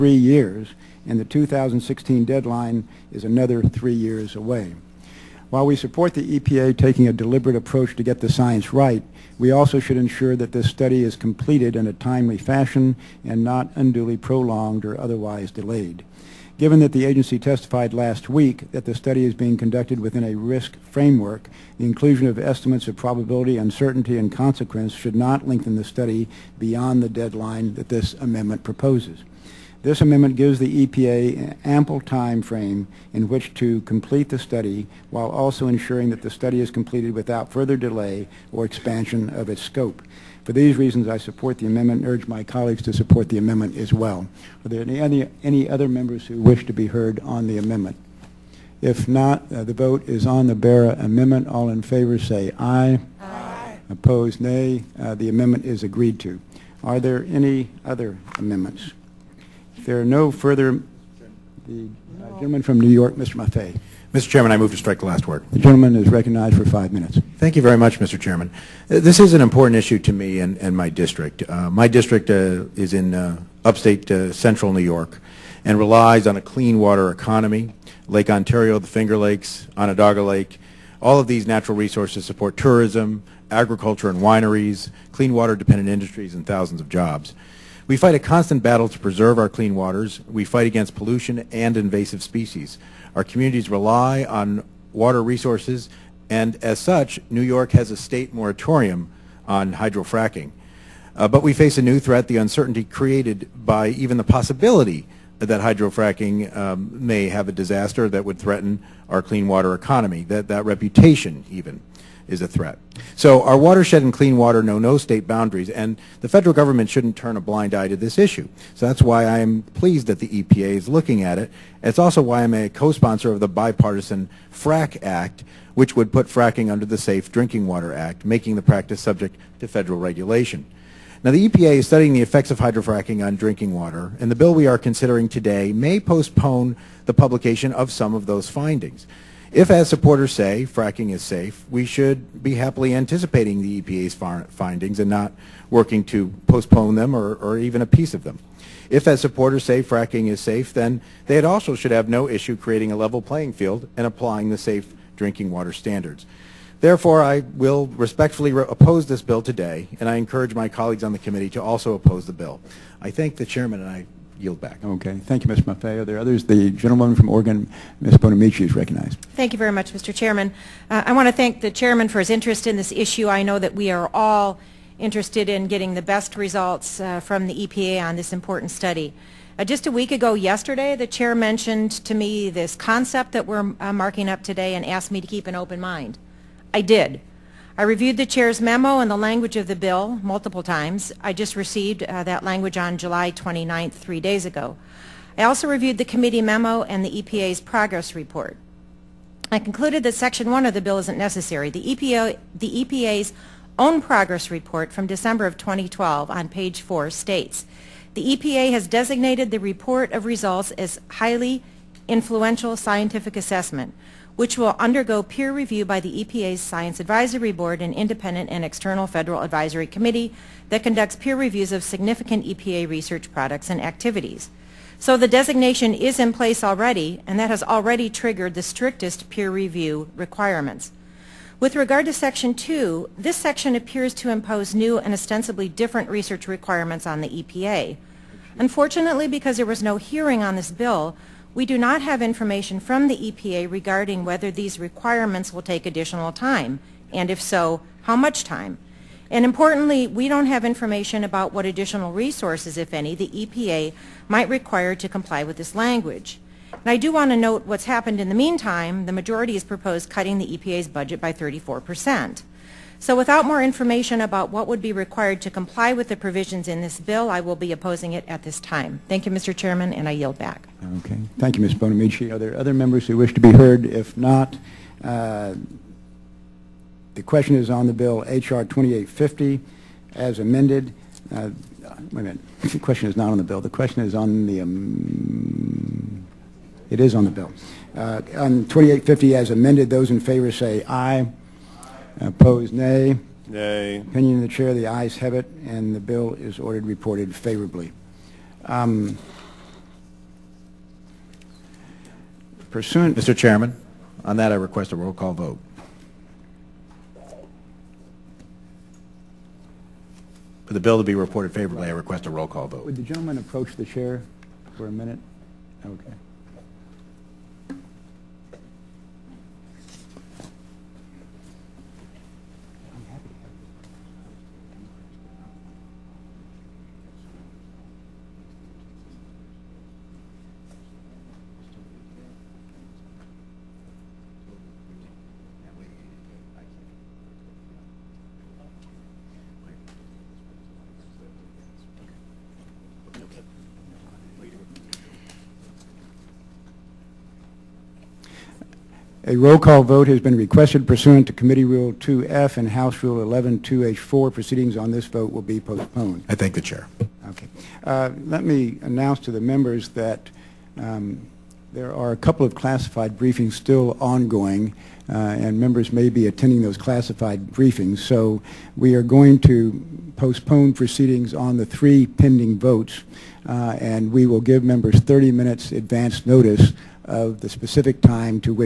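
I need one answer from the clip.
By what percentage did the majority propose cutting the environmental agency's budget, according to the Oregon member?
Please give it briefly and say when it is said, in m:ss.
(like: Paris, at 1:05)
34 percent, at 4:21.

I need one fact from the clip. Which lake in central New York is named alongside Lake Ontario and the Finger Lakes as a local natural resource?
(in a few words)
Onondaga Lake.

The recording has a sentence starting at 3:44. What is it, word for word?
So the designation is in place already, and that has already triggered the strictest peer review requirements.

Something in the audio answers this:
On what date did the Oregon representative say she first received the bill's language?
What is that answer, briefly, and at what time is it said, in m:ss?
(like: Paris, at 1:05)
July 29, at 3:12.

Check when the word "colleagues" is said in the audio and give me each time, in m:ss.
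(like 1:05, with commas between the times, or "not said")
0:42, 2:40.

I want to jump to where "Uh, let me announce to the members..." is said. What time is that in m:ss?
5:57.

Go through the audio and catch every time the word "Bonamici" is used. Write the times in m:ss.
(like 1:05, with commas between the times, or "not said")
2:48, 4:31.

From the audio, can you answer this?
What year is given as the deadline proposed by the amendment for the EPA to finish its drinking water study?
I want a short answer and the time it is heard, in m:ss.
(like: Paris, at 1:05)
2016, at 0:01.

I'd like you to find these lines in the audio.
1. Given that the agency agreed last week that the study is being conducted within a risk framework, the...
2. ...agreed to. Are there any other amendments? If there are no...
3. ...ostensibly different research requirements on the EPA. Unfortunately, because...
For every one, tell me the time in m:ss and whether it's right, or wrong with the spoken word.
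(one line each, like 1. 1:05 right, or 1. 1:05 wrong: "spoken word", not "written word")
1. 0:16 wrong: "testified", not "agreed"
2. 0:55 right
3. 3:55 right.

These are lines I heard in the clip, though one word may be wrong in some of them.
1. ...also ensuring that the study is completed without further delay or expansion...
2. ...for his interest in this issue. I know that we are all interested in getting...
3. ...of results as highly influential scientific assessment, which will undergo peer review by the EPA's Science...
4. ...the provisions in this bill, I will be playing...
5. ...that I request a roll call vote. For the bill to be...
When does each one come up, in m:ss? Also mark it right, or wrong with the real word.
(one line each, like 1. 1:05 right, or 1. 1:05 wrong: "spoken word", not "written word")
1. 0:35 right
2. 2:52 right
3. 3:30 right
4. 4:26 wrong: "opposing", not "playing"
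5. 5:04 right.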